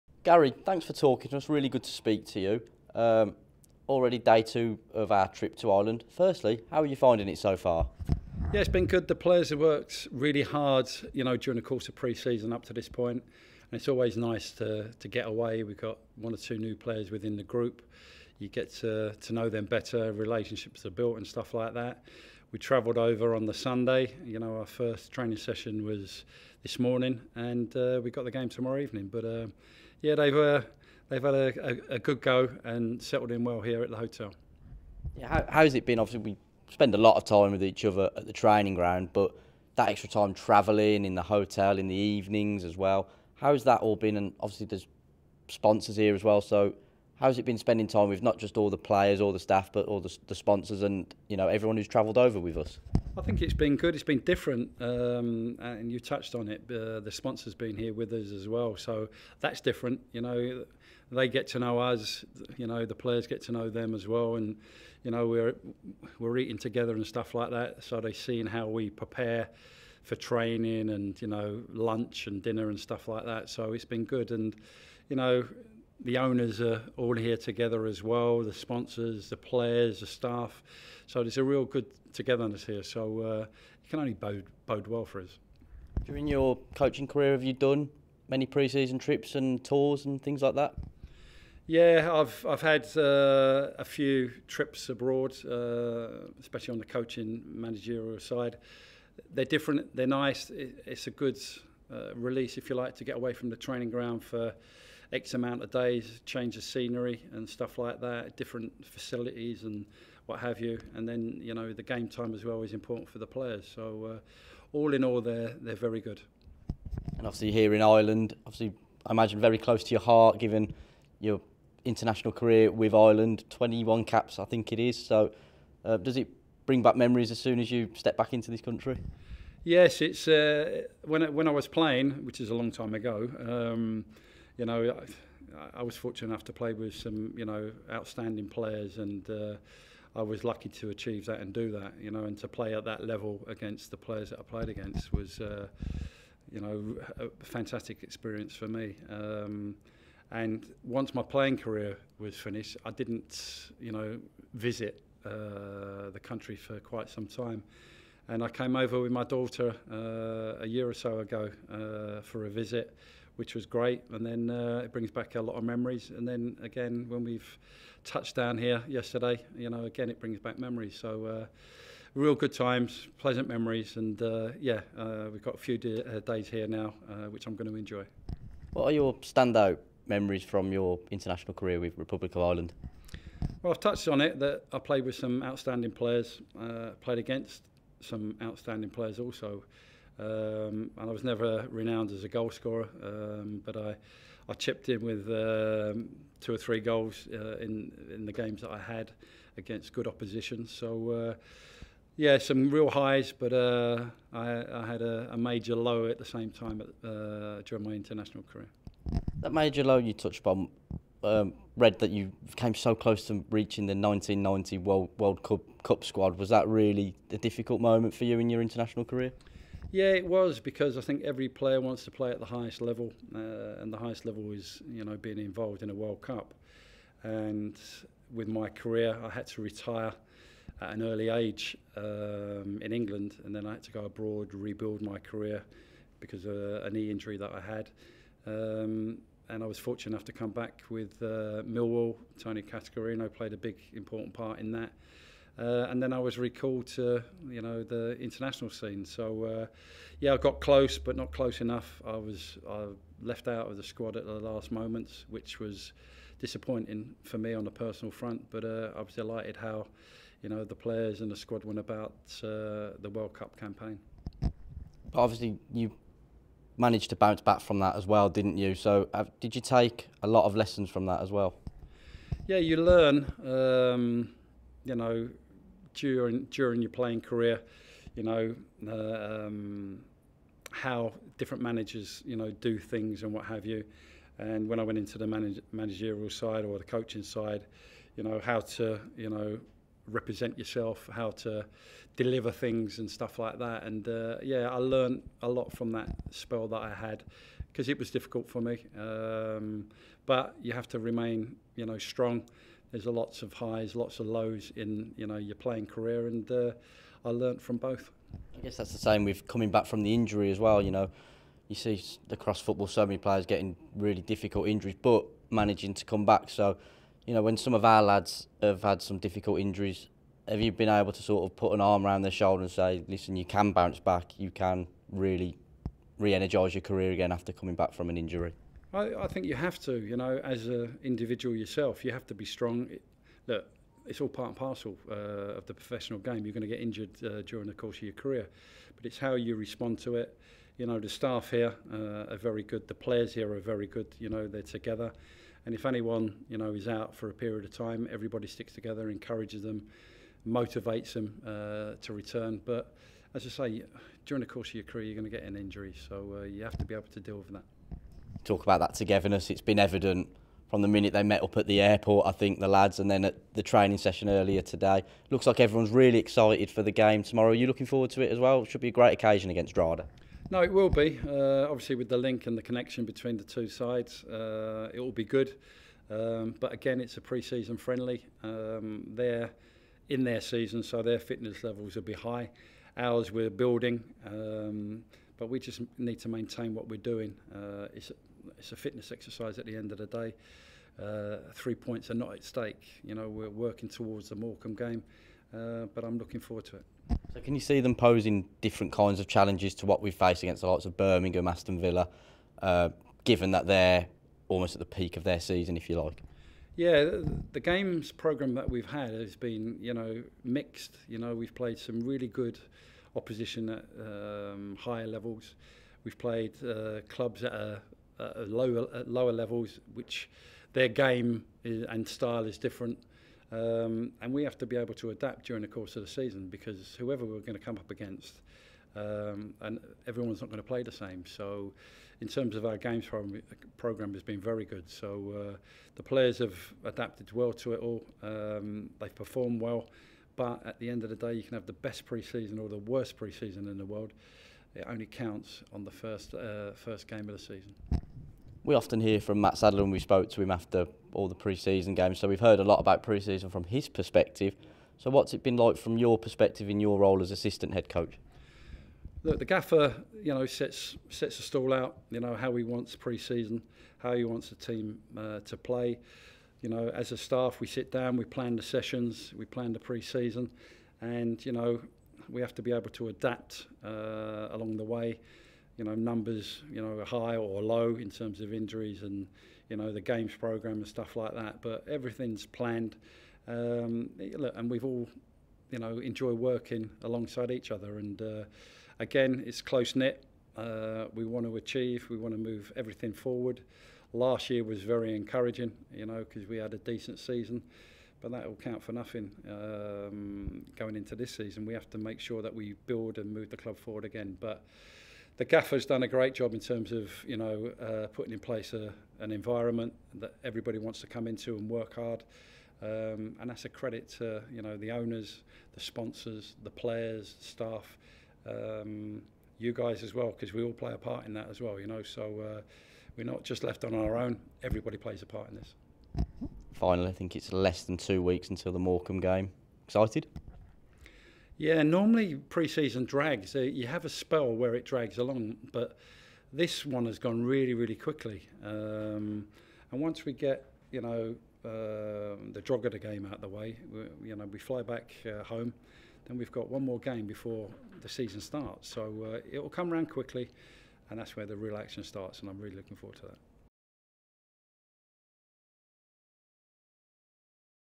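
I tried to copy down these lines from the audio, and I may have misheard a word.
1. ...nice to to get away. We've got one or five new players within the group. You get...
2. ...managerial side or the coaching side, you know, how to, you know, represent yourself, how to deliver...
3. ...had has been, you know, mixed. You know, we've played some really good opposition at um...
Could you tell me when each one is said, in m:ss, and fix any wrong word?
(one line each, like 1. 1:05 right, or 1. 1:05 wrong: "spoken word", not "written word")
1. 0:14 wrong: "two", not "five"
2. 4:45 right
3. 6:48 right.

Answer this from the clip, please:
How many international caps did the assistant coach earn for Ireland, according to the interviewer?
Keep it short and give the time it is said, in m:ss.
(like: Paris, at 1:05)
21, at 2:03.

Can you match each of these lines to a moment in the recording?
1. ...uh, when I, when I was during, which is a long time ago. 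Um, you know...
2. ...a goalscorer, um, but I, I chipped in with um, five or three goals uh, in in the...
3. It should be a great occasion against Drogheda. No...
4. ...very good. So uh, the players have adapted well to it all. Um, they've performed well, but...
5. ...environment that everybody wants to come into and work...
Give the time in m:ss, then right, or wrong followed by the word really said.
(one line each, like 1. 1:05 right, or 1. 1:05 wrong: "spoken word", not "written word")
1. 2:10 wrong: "playing", not "during"
2. 3:12 wrong: "two", not "five"
3. 6:08 right
4. 7:14 right
5. 8:29 right.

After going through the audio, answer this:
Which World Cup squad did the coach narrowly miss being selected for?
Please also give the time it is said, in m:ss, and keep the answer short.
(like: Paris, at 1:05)
1990, at 3:33.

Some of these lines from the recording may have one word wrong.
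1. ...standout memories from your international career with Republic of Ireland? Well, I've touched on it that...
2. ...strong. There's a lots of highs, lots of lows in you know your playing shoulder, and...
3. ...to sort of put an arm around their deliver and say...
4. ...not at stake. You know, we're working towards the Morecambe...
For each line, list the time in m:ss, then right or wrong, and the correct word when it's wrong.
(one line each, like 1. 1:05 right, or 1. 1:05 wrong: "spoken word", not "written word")
1. 2:59 right
2. 5:01 wrong: "career", not "shoulder"
3. 5:21 wrong: "shoulder", not "deliver"
4. 6:32 right.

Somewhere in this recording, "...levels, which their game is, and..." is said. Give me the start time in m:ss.
6:59.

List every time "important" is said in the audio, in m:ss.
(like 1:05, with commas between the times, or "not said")
1:52, 4:03.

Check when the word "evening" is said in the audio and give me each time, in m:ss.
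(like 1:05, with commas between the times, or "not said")
0:28, 0:41.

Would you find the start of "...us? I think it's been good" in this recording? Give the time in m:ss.
0:52.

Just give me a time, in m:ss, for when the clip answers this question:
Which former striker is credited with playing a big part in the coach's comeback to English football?
4:02.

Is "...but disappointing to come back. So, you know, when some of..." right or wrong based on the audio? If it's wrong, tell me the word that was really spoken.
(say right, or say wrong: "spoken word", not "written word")
wrong: "managing", not "disappointing".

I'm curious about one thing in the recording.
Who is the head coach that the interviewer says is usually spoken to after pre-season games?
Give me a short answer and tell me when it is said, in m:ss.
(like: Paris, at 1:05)
Mat Sadler, at 7:29.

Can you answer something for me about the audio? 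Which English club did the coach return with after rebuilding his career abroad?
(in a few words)
Millwall.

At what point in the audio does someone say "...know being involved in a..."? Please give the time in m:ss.
3:45.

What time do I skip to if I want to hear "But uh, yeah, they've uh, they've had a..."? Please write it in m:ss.
0:29.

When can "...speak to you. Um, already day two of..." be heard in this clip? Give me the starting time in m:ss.
0:01.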